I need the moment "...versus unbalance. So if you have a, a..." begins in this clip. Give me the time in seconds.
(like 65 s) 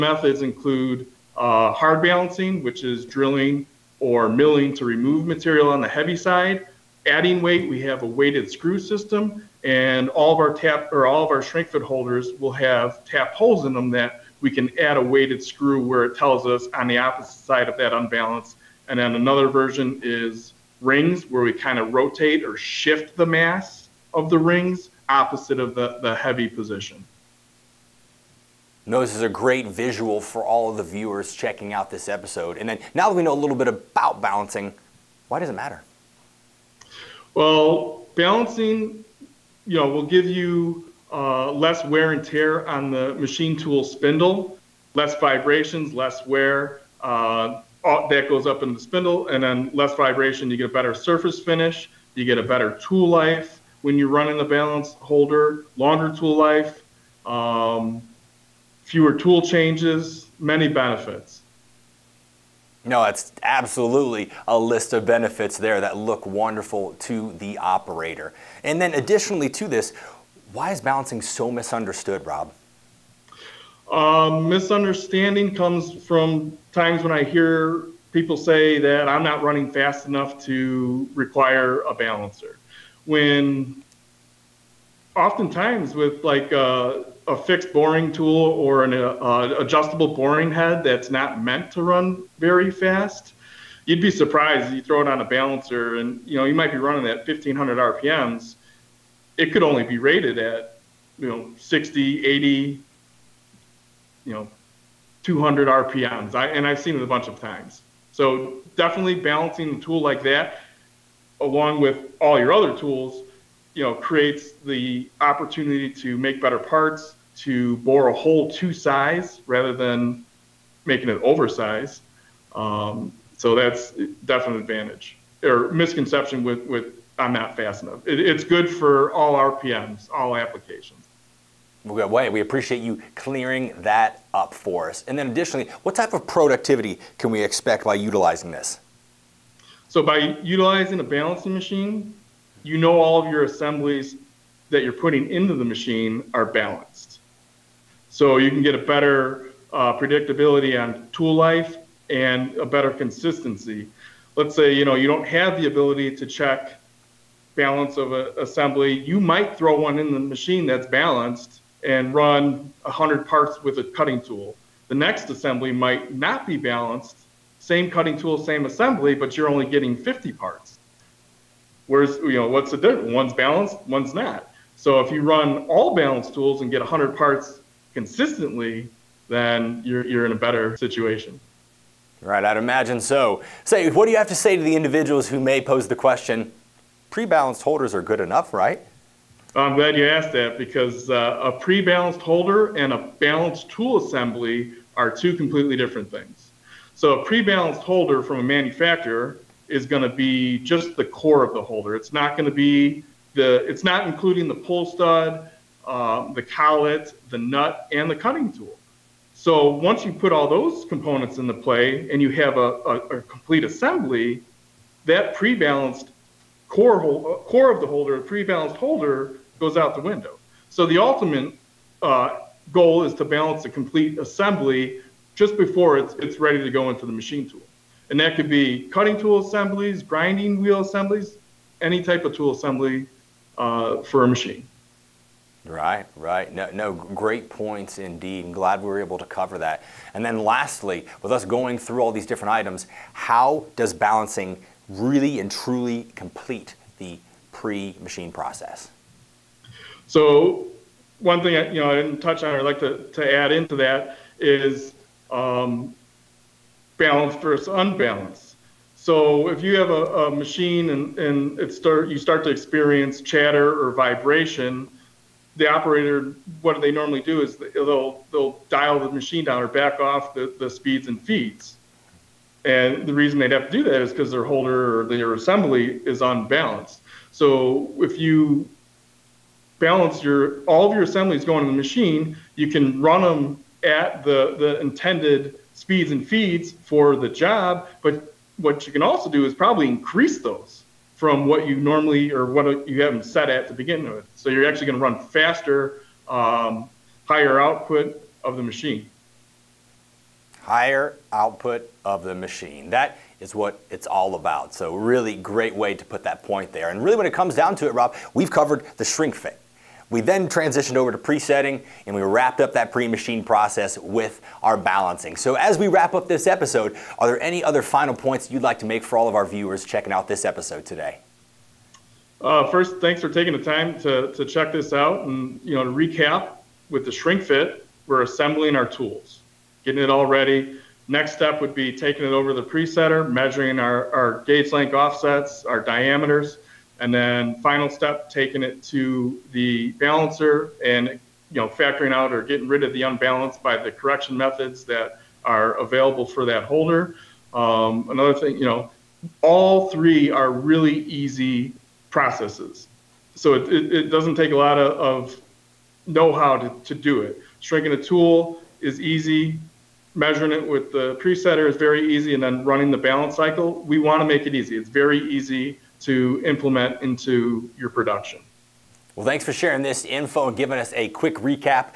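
257 s.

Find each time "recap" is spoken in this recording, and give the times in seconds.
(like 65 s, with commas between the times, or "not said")
325 s, 371 s.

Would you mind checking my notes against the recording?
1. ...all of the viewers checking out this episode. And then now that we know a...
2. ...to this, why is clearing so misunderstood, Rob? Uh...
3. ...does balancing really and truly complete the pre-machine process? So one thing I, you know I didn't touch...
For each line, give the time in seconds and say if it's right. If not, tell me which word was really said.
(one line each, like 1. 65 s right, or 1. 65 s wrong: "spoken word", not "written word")
1. 30 s right
2. 69 s wrong: "balancing", not "clearing"
3. 243 s right.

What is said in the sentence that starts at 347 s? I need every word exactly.
Um, another thing, you know, all three are really easy processes.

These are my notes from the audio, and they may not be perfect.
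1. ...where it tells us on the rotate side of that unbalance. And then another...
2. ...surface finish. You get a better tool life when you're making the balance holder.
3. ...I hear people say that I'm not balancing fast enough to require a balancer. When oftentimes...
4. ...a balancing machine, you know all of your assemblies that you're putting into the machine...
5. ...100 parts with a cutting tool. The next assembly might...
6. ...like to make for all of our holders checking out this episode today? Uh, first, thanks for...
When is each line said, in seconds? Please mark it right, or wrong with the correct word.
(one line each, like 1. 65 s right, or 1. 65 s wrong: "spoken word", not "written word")
1. 15 s wrong: "opposite", not "rotate"
2. 50 s wrong: "running", not "making"
3. 77 s wrong: "running", not "balancing"
4. 140 s right
5. 162 s right
6. 318 s wrong: "viewers", not "holders".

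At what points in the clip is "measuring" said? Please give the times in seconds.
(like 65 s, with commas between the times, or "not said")
333 s, 360 s.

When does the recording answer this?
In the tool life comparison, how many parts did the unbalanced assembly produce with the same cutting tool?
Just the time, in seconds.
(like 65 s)
169 s.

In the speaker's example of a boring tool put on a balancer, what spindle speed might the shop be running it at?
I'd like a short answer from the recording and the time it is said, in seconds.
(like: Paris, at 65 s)
1500 RPM, at 97 s.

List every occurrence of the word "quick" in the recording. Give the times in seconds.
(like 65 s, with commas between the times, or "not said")
371 s.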